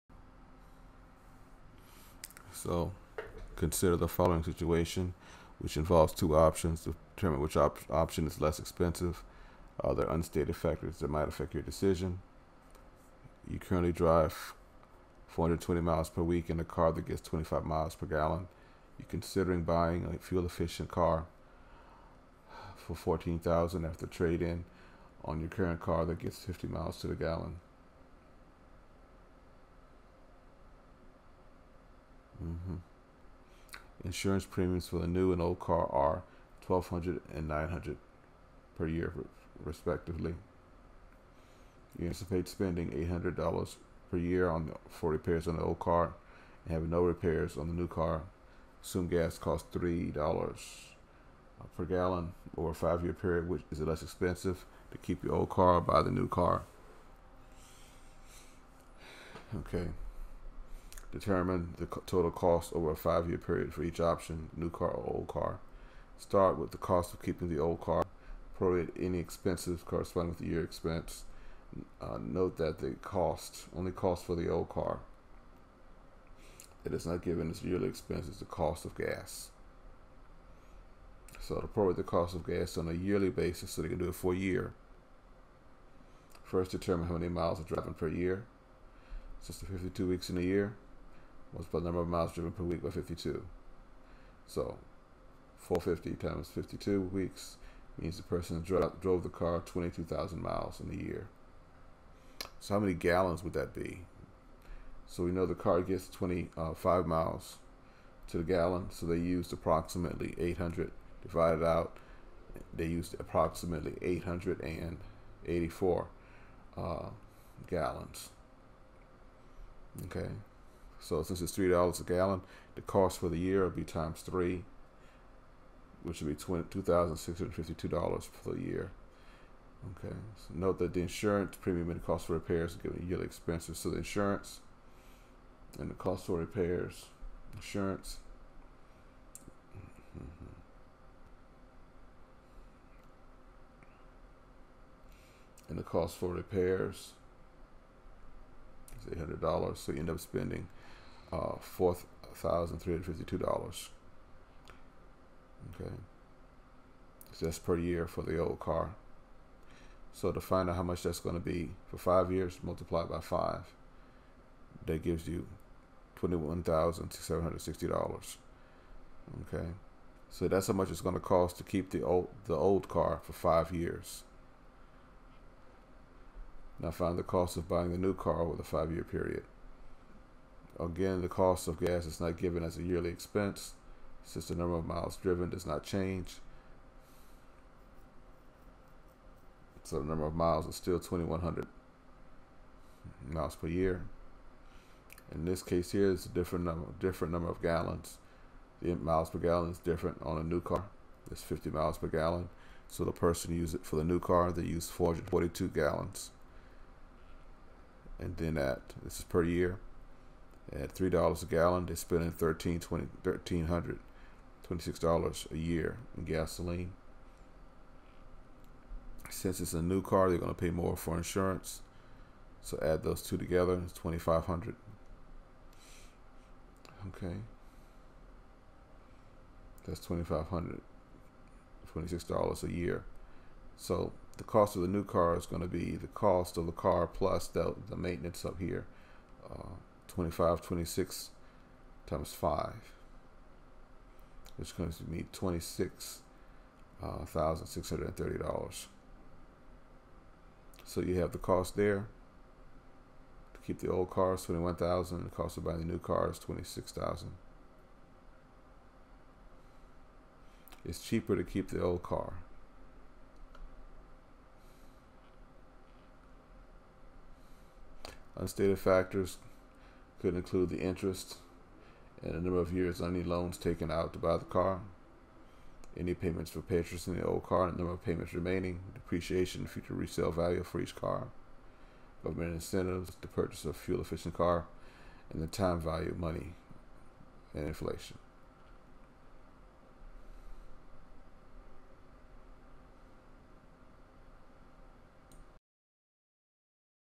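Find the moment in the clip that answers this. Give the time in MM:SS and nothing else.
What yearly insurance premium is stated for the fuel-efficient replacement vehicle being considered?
00:36.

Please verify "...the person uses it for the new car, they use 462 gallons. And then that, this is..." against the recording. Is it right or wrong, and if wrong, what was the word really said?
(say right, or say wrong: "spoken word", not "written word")
wrong: "442", not "462".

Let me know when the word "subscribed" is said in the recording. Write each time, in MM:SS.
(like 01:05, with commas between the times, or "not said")
not said.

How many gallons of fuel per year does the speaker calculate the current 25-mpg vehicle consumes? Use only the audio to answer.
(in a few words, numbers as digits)
884.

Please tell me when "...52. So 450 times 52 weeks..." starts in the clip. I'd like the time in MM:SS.
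01:32.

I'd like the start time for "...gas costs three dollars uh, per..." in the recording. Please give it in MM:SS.
00:49.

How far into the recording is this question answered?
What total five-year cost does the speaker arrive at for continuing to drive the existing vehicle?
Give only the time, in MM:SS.
02:46.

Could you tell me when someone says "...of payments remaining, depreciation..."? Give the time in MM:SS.
04:37.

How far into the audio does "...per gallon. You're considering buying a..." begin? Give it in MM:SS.
00:17.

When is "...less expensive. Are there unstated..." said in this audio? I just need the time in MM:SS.
00:08.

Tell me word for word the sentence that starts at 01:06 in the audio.
Start with the cost of keeping the old car, prorate any expenses corresponding with the year expense.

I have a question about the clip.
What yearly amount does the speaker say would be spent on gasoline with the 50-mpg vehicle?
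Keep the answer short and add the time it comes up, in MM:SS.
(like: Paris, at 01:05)
$1,326, at 03:33.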